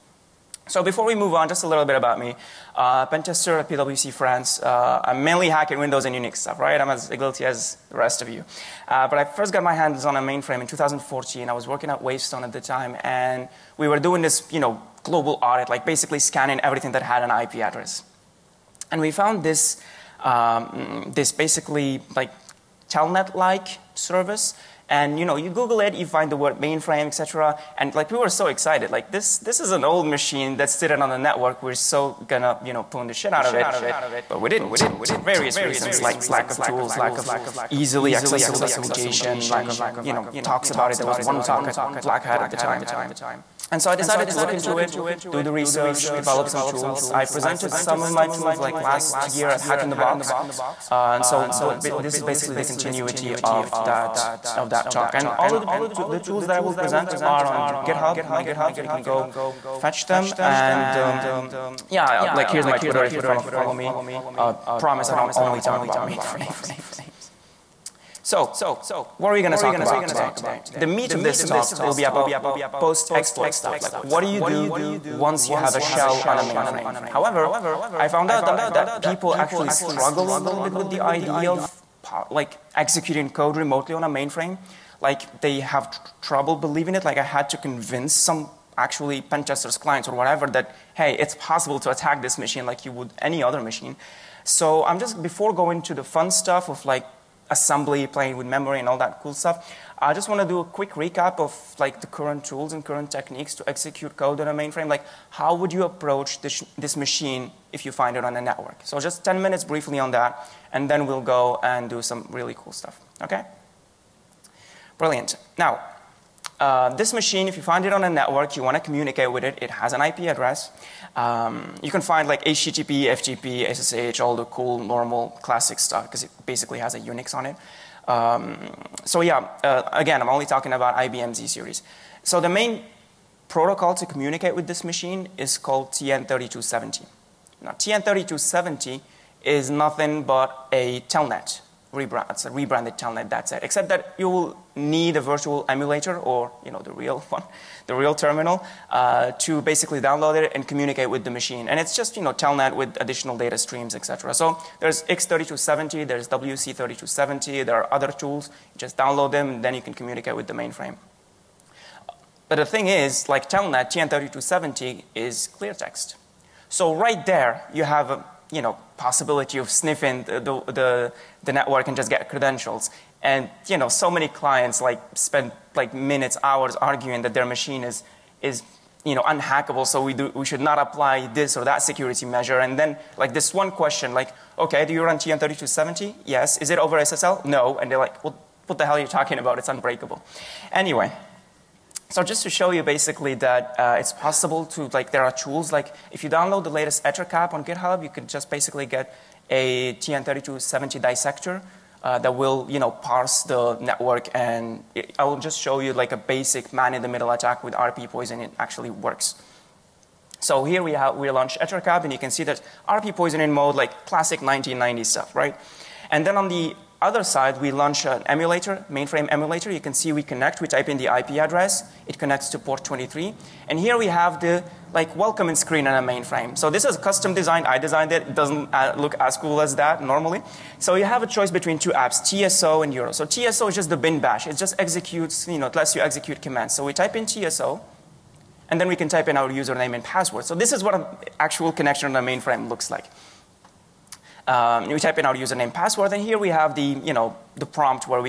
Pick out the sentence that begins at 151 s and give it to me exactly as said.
And it's just you know telnet with additional data streams, etc.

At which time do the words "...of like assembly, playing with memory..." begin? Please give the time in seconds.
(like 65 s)
96 s.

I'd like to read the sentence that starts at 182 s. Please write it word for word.
And then, like, this one question, like, okay, do you run TN3270?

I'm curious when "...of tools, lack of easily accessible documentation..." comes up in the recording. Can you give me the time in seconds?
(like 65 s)
36 s.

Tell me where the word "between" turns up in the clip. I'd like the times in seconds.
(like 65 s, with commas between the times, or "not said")
231 s.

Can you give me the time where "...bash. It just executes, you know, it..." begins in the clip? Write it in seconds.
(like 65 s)
234 s.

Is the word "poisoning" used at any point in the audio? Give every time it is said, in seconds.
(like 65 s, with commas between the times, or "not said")
208 s, 213 s.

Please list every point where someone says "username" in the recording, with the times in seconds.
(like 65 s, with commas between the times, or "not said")
239 s, 245 s.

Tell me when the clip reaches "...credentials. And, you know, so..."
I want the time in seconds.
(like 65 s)
172 s.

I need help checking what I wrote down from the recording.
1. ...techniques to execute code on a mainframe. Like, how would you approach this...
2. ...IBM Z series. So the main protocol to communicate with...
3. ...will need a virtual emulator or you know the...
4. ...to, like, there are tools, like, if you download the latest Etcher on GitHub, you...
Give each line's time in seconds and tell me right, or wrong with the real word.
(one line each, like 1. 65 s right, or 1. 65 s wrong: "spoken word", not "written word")
1. 103 s right
2. 130 s right
3. 144 s right
4. 194 s right.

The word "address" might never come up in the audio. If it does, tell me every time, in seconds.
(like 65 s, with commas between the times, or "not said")
17 s, 120 s, 221 s.